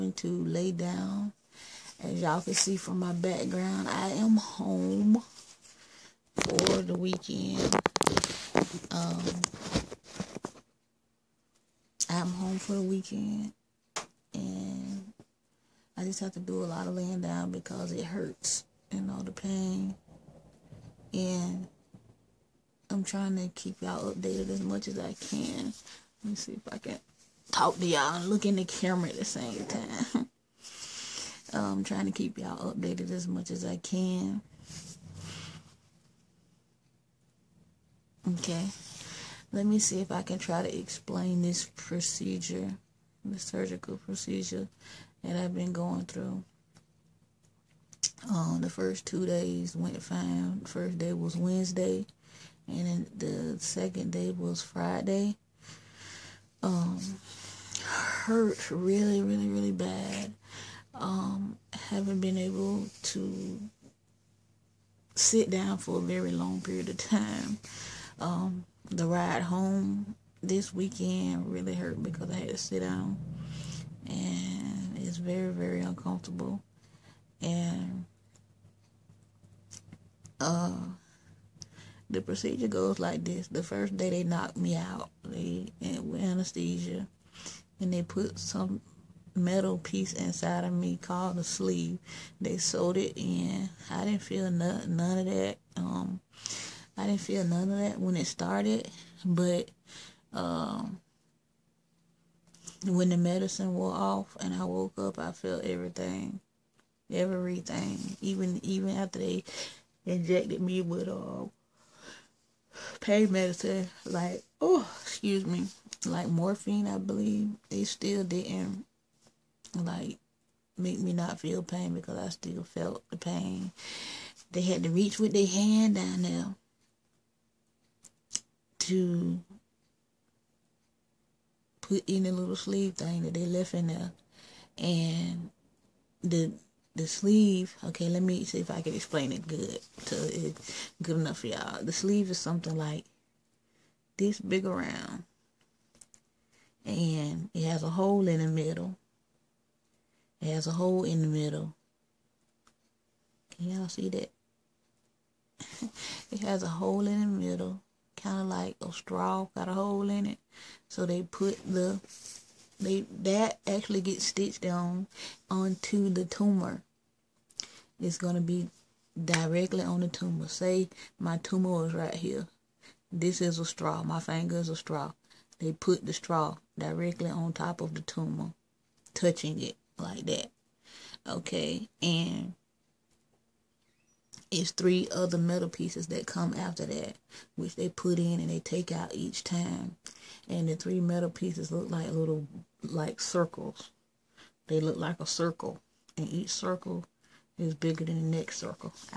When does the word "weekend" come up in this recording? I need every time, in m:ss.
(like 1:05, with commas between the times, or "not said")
0:06, 0:12, 1:10.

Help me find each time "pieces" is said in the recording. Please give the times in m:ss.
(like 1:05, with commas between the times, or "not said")
1:29, 3:05, 3:11.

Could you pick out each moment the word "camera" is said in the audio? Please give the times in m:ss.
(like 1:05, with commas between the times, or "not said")
0:28.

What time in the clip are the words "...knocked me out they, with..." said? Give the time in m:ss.
1:24.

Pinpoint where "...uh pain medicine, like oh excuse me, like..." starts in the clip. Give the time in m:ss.
1:51.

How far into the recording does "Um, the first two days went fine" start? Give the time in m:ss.
0:48.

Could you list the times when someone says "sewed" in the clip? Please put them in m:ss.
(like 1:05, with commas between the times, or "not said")
1:32.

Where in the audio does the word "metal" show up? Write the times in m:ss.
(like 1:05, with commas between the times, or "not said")
1:29, 3:05, 3:10.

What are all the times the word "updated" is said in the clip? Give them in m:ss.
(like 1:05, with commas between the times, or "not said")
0:24, 0:32.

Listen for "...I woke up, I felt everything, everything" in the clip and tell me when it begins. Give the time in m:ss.
1:44.